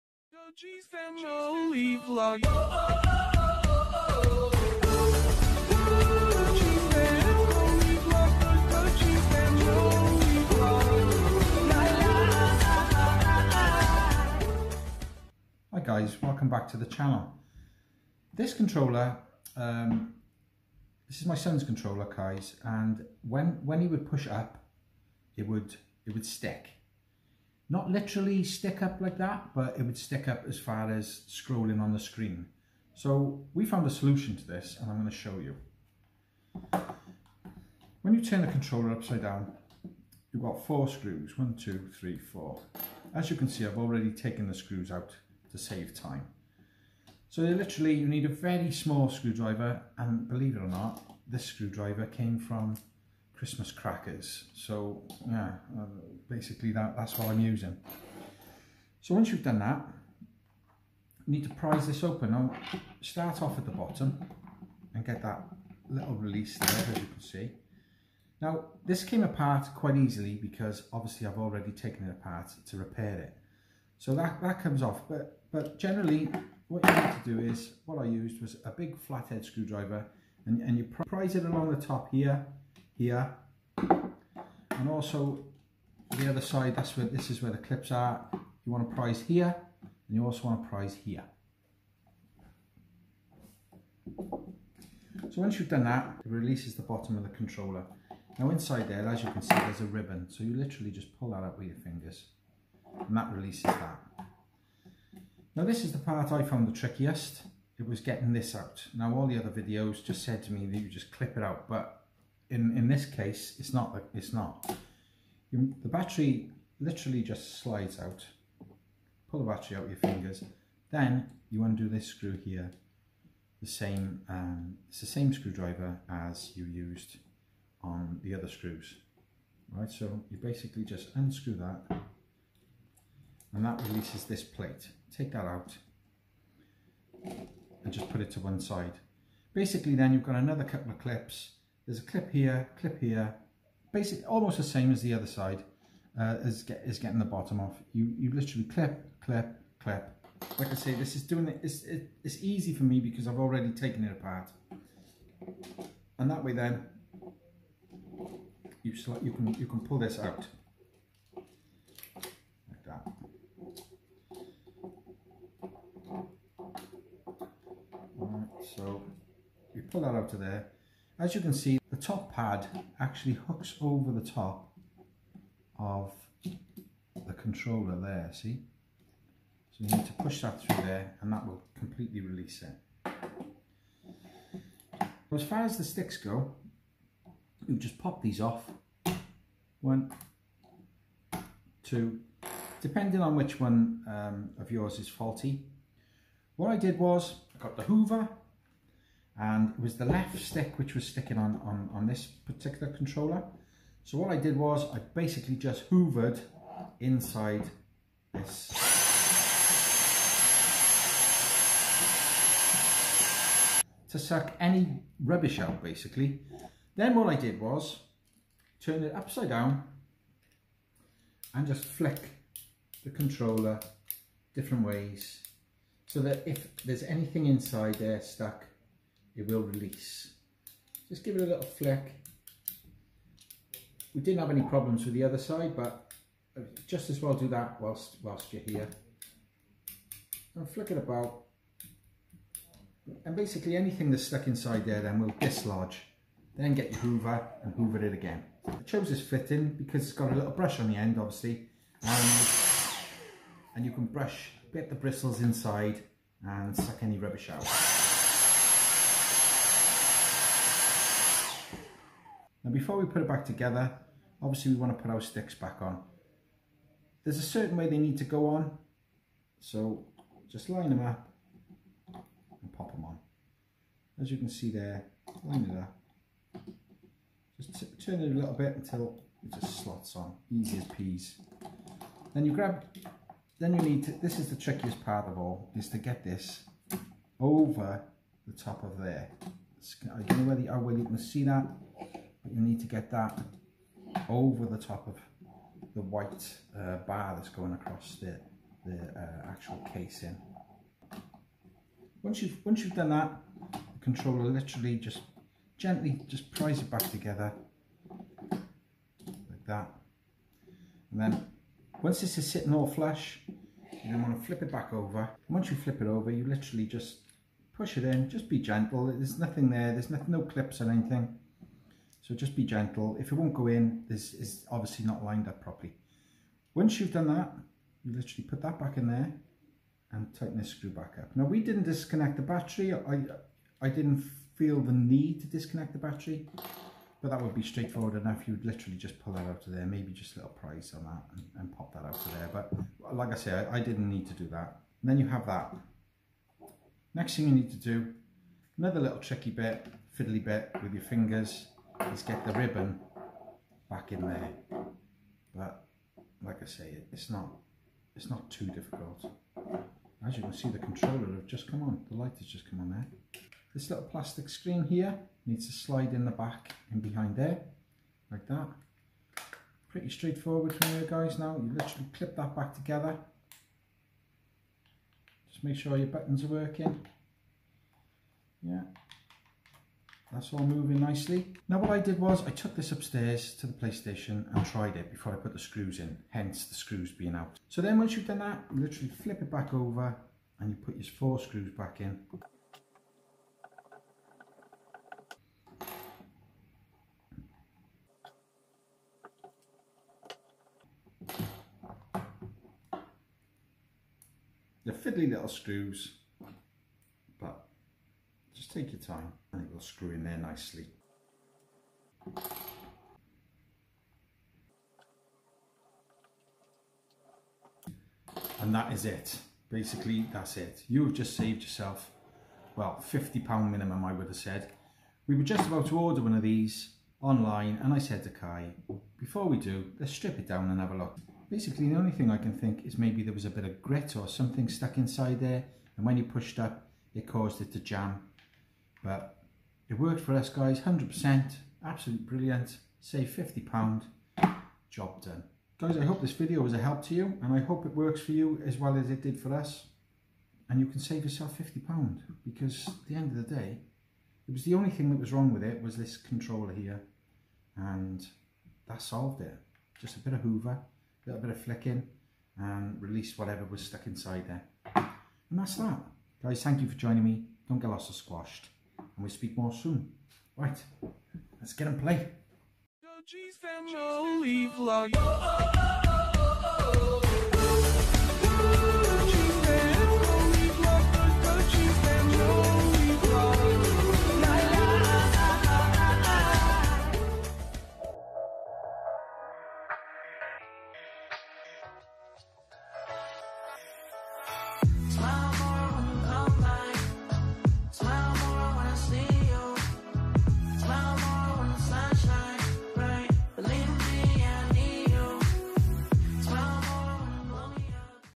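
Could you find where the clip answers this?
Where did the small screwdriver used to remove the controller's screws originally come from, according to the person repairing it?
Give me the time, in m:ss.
0:53.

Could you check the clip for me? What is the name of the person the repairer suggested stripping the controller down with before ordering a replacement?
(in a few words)
Kai.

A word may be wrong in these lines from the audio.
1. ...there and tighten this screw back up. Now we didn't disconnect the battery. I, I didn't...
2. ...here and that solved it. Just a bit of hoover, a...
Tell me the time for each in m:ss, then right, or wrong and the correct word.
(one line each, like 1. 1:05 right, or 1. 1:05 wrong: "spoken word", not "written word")
1. 5:29 right
2. 7:36 right.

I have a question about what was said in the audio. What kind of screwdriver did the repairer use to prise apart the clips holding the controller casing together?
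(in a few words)
big flathead screwdriver.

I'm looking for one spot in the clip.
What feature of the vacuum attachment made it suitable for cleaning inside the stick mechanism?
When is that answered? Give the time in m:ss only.
4:10.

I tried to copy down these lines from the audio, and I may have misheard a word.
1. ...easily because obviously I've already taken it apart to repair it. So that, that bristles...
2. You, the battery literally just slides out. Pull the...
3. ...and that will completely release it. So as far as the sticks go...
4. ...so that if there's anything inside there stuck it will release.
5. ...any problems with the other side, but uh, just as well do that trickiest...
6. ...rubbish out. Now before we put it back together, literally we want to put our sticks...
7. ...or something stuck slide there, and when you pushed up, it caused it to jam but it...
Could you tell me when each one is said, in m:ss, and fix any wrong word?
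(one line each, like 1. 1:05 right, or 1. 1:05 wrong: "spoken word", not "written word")
1. 1:09 wrong: "comes", not "bristles"
2. 1:55 right
3. 3:01 right
4. 3:46 right
5. 3:54 wrong: "whilst", not "trickiest"
6. 4:17 wrong: "obviously", not "literally"
7. 7:14 wrong: "inside", not "slide".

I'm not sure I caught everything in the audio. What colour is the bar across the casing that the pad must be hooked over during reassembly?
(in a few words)
white.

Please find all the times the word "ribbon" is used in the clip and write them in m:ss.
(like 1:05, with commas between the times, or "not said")
1:39, 5:52.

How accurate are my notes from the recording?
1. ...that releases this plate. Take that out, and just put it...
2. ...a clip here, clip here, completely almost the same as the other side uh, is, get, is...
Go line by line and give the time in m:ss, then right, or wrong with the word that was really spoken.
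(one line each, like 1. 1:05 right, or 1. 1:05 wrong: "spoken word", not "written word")
1. 2:13 right
2. 2:22 wrong: "basically", not "completely".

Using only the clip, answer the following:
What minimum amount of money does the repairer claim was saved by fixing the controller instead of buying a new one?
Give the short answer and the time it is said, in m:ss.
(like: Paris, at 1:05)
£50, at 7:03.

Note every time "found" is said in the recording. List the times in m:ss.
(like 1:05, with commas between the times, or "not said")
0:33, 1:46.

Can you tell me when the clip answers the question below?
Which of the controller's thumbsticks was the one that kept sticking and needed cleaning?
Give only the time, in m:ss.
3:20.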